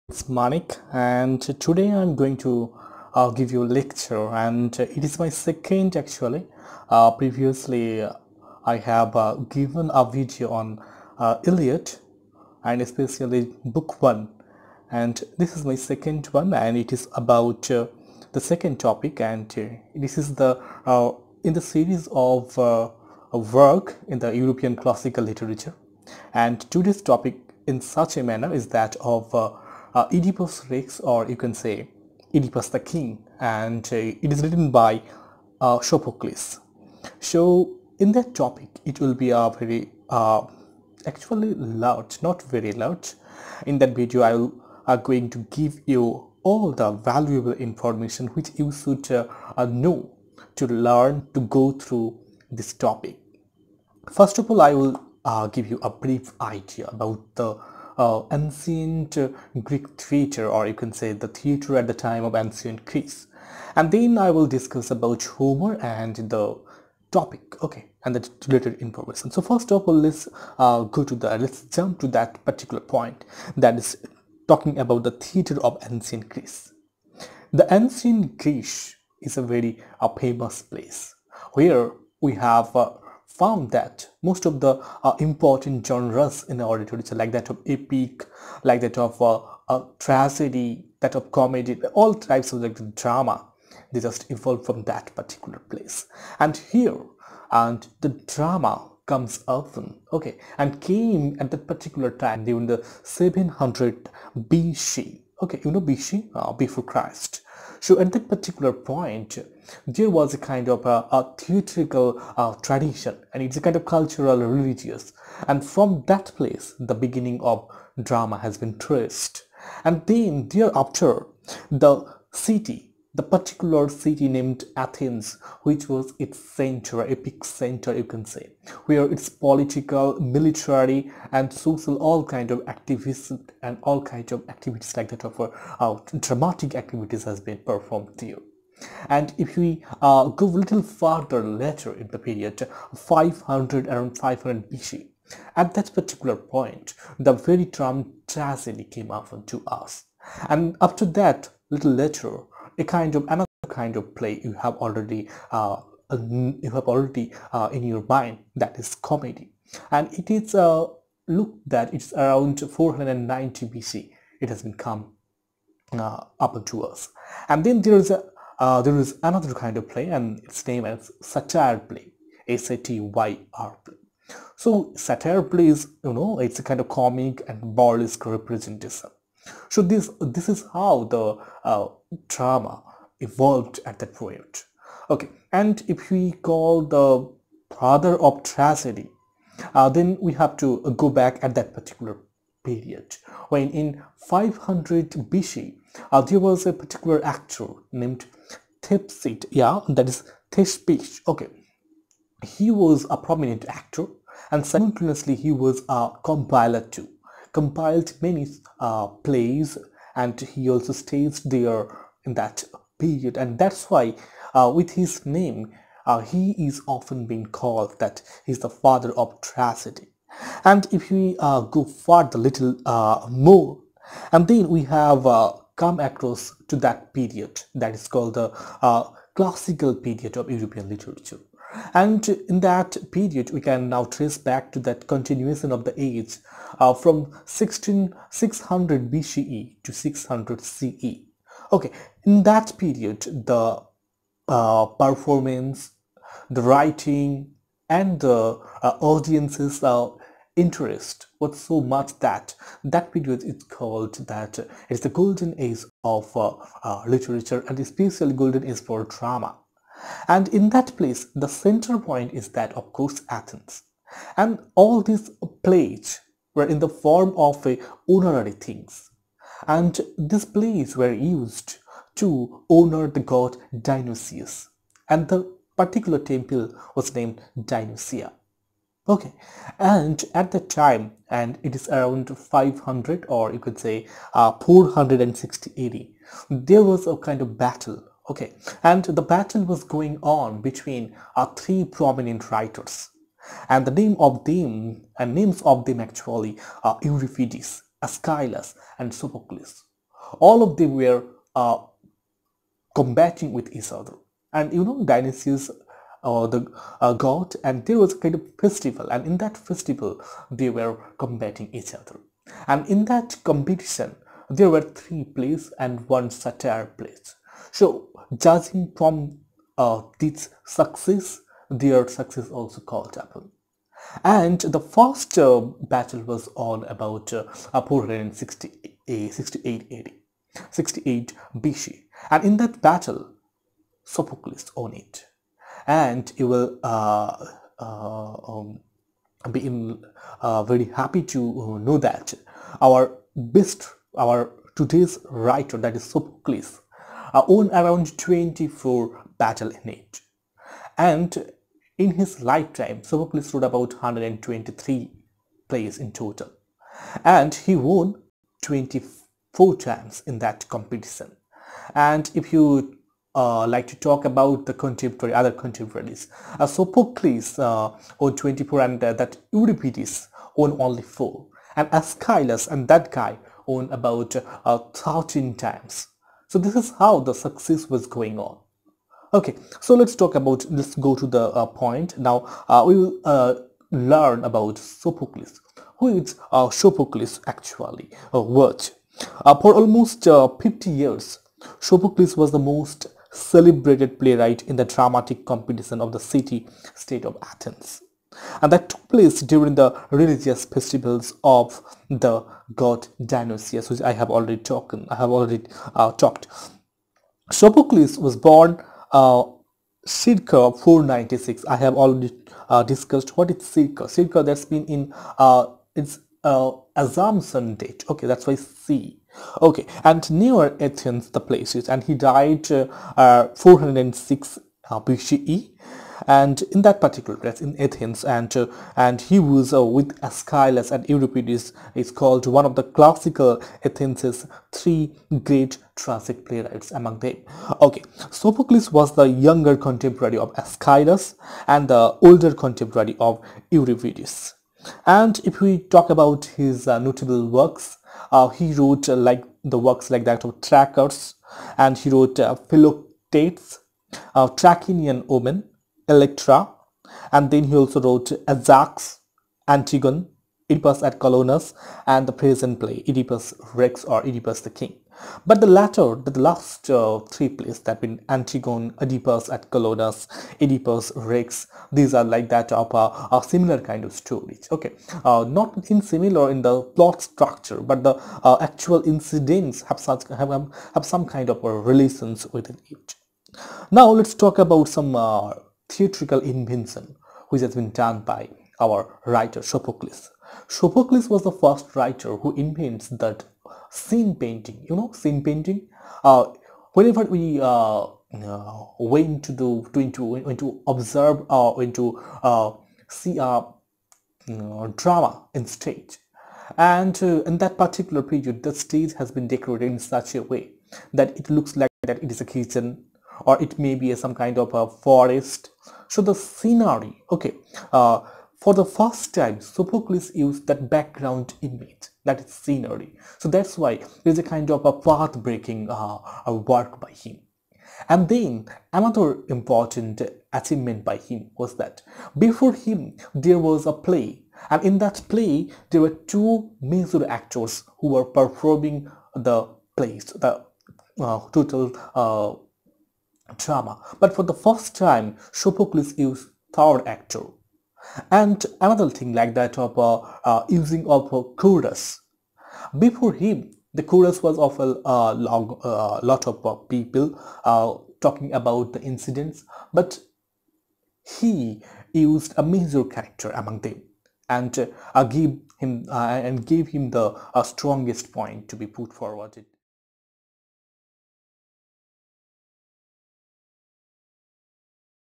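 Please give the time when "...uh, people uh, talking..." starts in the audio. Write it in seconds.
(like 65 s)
556 s.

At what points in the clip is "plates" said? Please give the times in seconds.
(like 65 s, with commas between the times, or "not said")
265 s, 270 s.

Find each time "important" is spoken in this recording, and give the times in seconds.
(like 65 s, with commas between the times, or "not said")
85 s, 529 s.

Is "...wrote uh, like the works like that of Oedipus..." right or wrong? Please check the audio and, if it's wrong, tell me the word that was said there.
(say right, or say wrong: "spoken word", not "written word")
wrong: "Trackers", not "Oedipus".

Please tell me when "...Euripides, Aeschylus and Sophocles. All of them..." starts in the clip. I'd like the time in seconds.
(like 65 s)
297 s.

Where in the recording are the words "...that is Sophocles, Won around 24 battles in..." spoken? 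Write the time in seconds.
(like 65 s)
345 s.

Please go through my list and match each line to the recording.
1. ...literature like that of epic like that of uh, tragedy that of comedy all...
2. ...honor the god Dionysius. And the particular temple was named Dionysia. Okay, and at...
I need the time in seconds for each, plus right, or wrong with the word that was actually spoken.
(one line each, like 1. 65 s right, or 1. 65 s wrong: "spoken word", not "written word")
1. 86 s right
2. 272 s right.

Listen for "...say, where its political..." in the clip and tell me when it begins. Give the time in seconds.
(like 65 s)
128 s.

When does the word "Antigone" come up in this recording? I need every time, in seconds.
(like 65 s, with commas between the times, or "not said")
459 s, 468 s.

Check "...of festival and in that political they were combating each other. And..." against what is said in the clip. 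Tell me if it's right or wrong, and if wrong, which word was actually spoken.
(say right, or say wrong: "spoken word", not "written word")
wrong: "festival", not "political".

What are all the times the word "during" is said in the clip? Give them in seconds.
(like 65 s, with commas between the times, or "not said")
102 s, 399 s.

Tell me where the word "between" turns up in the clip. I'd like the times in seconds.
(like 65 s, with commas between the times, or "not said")
290 s.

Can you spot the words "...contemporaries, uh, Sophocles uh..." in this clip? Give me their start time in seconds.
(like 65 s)
365 s.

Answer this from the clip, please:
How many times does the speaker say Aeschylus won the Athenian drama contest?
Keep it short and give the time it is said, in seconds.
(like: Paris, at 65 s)
13, at 374 s.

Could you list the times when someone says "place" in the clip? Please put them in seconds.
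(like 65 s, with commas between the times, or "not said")
80 s, 95 s, 116 s, 260 s, 399 s, 421 s.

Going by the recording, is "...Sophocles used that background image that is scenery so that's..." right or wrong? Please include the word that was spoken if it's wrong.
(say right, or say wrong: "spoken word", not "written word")
right.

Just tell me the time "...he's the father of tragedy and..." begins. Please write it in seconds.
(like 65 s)
218 s.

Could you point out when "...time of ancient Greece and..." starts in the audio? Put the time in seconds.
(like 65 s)
61 s.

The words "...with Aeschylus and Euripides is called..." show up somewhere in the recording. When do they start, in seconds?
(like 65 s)
429 s.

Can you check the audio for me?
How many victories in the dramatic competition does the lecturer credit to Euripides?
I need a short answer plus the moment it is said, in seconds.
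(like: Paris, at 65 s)
4, at 371 s.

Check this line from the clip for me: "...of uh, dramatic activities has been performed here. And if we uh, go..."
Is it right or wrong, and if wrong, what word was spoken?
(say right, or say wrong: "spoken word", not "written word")
right.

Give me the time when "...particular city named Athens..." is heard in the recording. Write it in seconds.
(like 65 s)
123 s.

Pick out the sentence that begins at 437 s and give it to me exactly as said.
Okay, Sophocles was the younger contemporary of Aeschylus and the older contemporary of Euripides.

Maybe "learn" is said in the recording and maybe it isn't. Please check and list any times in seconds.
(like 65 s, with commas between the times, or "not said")
50 s, 383 s.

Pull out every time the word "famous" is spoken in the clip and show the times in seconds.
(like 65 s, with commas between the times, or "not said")
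80 s.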